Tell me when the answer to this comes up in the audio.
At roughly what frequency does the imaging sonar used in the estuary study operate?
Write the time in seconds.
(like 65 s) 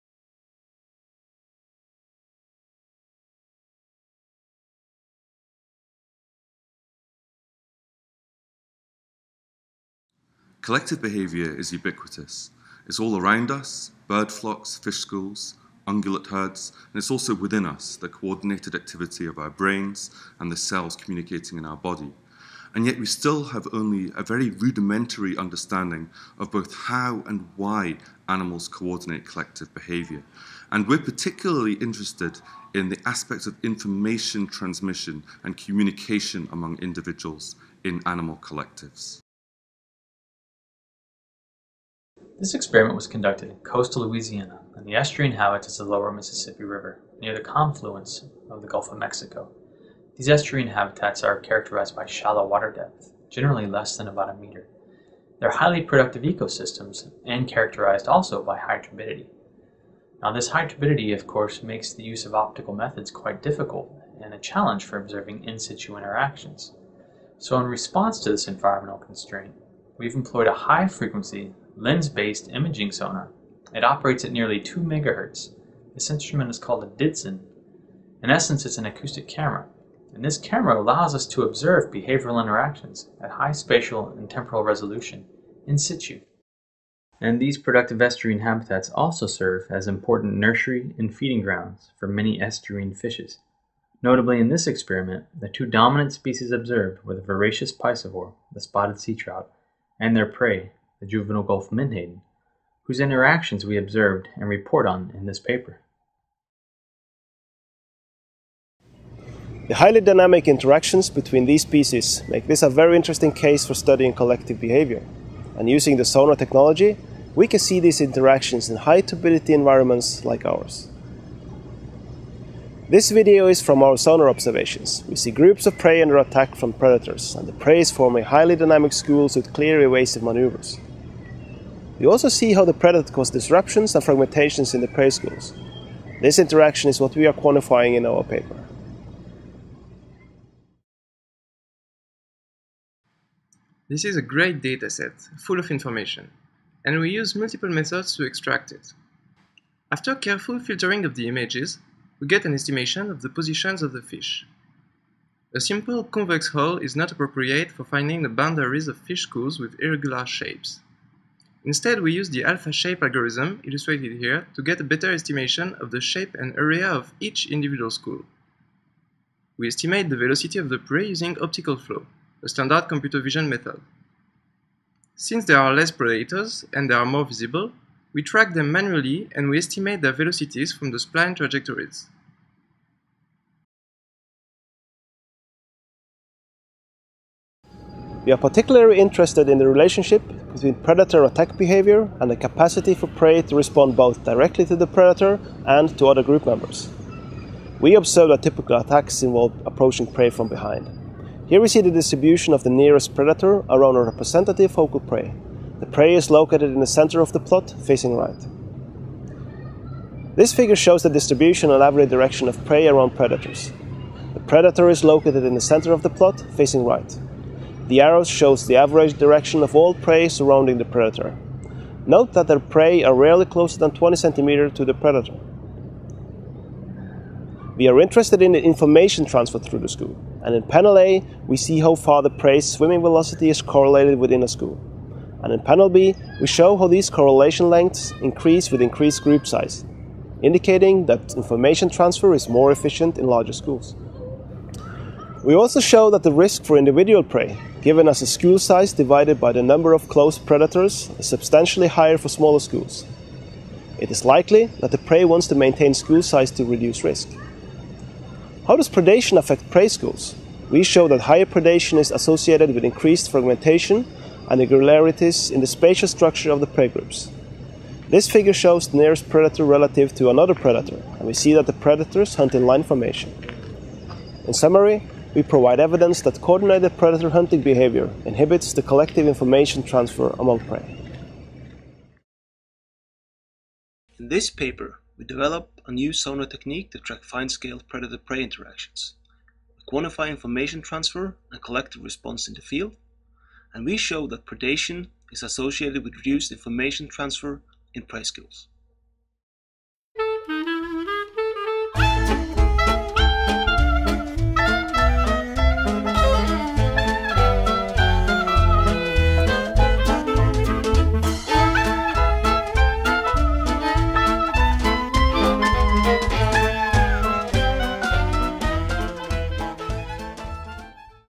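74 s.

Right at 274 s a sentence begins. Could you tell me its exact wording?
In summary, we provide evidence that coordinated predator hunting behavior inhibits the collective information transfer among prey.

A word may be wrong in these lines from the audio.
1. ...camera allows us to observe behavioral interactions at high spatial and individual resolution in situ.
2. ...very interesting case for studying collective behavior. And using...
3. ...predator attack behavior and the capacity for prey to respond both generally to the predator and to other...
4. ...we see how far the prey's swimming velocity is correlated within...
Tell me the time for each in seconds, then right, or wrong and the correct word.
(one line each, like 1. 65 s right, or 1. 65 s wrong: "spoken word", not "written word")
1. 80 s wrong: "temporal", not "individual"
2. 112 s right
3. 190 s wrong: "directly", not "generally"
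4. 231 s right.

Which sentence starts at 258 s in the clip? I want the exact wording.
How does predation affect prey schools?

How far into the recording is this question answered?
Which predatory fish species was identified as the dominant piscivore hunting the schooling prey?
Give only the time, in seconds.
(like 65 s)
98 s.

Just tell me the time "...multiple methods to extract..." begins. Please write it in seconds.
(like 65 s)
147 s.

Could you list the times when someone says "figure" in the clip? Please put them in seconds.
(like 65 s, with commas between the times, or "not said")
210 s, 268 s.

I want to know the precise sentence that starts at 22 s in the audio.
And yet, we still have only a very rudimentary understanding of both how and why animals coordinate collective behaviour.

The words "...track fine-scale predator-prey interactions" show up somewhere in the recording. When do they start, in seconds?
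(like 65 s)
286 s.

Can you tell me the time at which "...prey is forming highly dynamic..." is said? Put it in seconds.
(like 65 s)
127 s.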